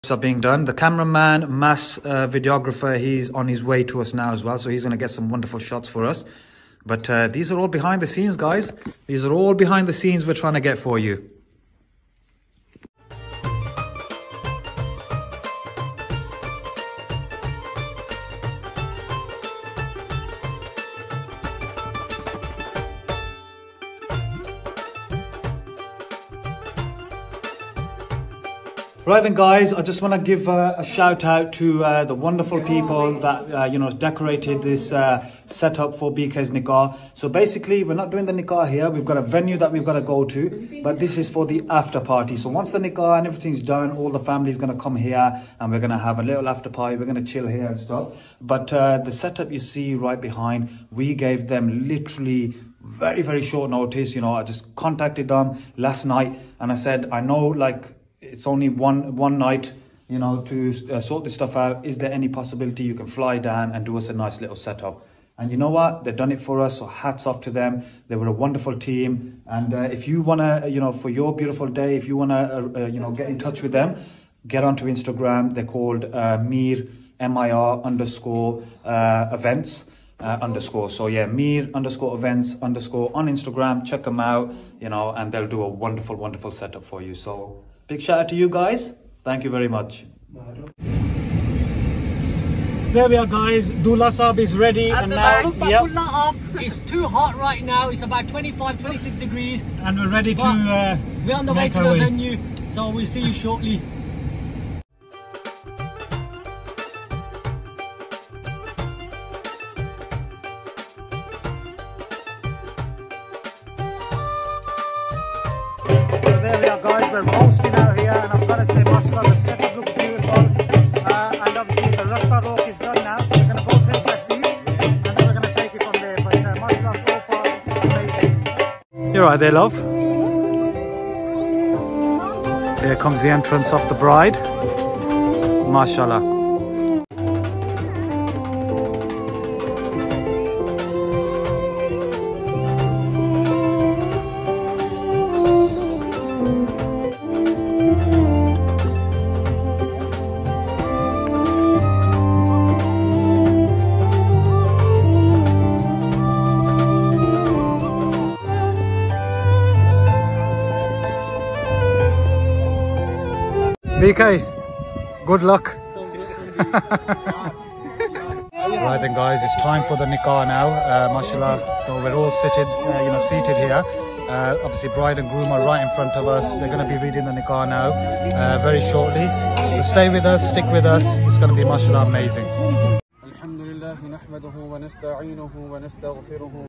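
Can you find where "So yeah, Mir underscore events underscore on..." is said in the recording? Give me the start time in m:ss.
1:20.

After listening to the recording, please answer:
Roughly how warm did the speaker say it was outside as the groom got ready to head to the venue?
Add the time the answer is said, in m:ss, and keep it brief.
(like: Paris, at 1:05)
25-26 degrees, at 1:38.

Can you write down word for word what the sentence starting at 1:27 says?
So Big shout out to you guys.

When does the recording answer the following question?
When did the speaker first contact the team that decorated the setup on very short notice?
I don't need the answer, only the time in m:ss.
0:55.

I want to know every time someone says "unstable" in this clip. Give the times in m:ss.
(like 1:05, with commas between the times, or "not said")
not said.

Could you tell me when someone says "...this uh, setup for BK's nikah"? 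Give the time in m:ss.
0:34.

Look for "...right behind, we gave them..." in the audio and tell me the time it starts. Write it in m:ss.
0:49.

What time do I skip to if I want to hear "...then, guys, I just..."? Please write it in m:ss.
0:29.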